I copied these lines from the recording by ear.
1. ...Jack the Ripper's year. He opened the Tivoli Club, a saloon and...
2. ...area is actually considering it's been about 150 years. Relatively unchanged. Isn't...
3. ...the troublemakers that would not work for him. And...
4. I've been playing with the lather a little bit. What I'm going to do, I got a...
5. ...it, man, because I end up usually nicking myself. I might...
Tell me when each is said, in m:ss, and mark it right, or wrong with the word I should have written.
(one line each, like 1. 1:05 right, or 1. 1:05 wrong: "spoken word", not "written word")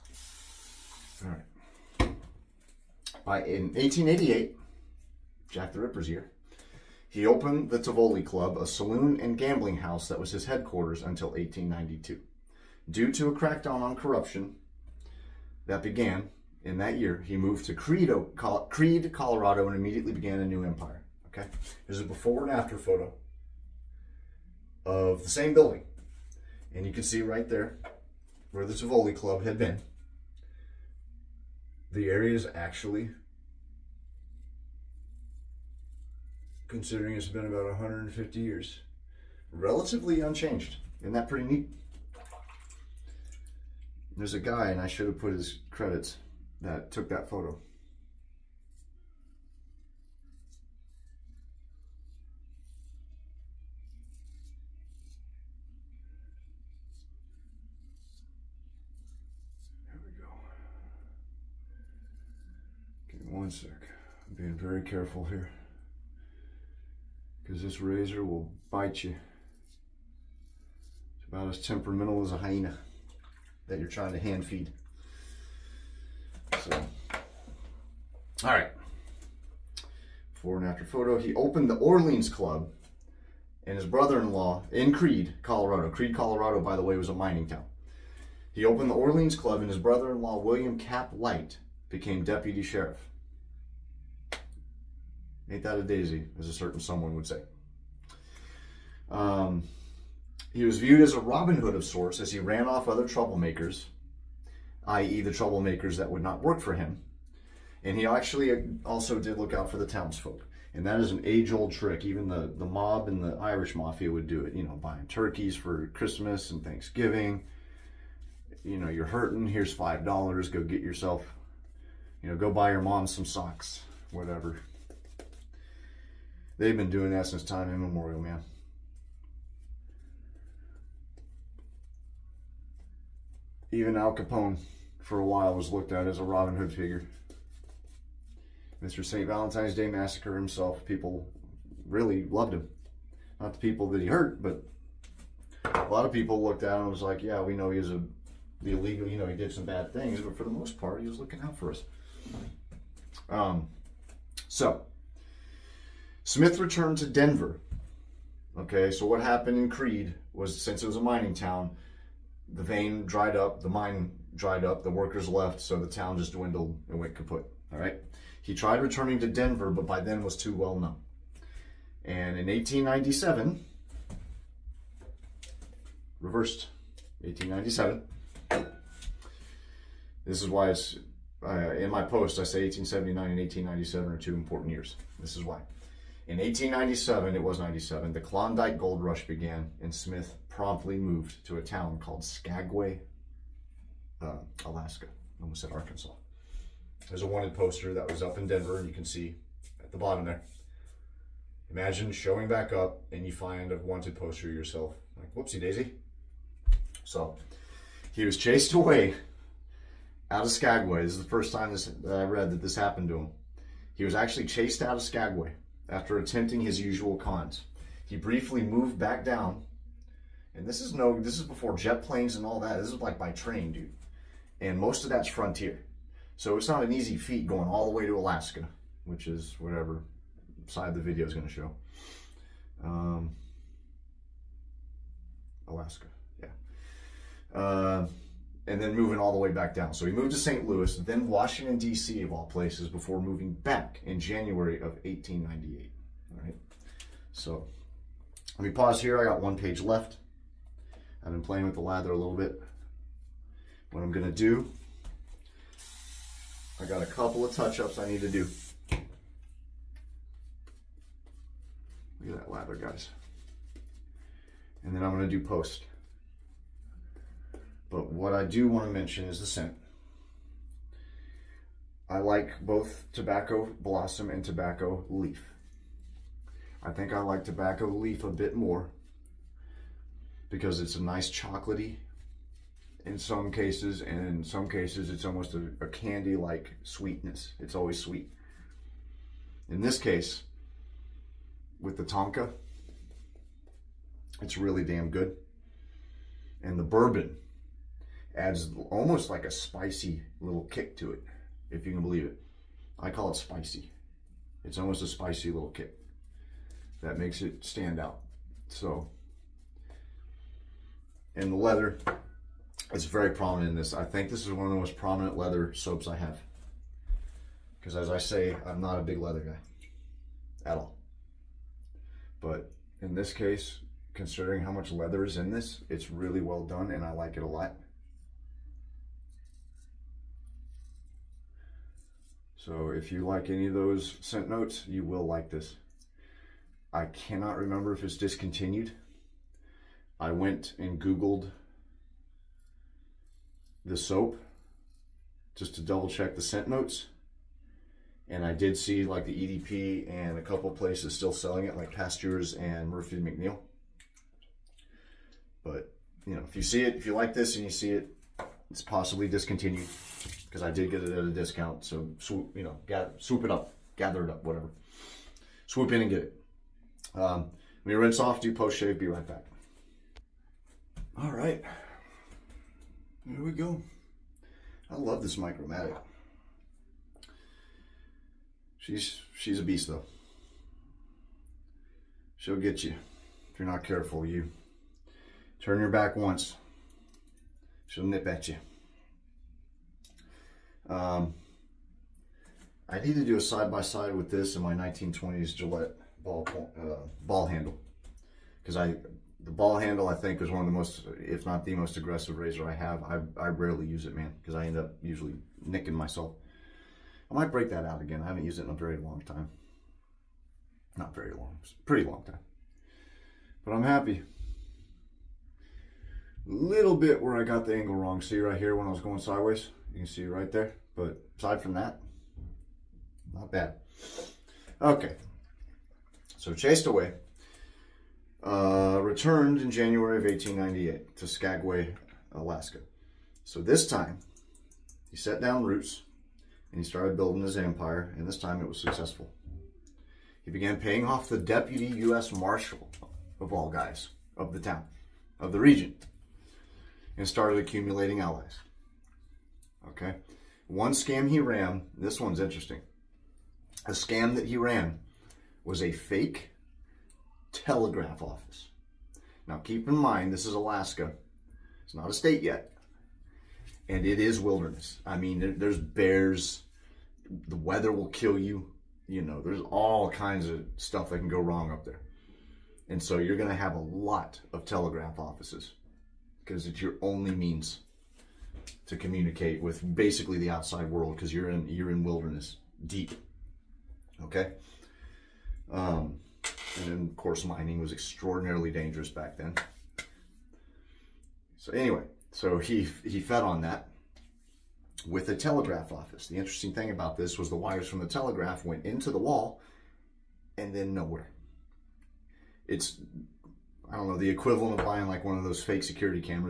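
1. 0:05 right
2. 0:32 right
3. 1:45 right
4. 4:11 right
5. 6:44 right.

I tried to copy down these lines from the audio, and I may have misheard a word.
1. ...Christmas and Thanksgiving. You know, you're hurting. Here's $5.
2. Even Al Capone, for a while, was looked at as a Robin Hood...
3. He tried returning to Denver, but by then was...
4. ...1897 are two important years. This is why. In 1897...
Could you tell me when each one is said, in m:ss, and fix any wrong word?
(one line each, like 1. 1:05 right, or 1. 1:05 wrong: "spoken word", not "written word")
1. 1:55 right
2. 2:13 right
3. 2:48 right
4. 3:03 right.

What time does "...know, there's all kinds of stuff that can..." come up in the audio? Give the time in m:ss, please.
7:49.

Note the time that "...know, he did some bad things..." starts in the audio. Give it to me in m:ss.
2:29.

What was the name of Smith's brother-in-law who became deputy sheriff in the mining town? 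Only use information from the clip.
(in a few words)
William Cap Light.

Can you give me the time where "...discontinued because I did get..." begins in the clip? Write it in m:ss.
5:59.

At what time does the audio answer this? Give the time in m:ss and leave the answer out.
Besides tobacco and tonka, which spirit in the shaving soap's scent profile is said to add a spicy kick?
4:56.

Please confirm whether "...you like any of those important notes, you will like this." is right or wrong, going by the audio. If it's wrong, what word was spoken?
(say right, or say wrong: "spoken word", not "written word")
wrong: "scent", not "important".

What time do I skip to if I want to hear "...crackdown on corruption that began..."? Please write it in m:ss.
0:13.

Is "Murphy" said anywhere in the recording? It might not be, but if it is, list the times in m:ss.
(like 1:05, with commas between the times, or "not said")
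5:52.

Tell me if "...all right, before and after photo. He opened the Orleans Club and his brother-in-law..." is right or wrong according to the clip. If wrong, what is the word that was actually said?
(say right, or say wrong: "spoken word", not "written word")
right.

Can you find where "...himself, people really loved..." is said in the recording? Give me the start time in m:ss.
2:20.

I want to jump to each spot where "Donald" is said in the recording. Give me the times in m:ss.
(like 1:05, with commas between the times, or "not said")
not said.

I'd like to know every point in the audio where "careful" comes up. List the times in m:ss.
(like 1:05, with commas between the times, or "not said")
1:04, 6:23.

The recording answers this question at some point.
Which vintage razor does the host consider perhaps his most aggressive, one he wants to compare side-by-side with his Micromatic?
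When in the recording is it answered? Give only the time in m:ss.
6:34.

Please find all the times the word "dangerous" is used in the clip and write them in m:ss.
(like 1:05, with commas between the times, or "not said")
8:08.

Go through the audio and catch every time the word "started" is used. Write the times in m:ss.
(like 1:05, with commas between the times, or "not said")
7:16, 7:27.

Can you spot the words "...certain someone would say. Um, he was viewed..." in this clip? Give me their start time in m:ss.
1:36.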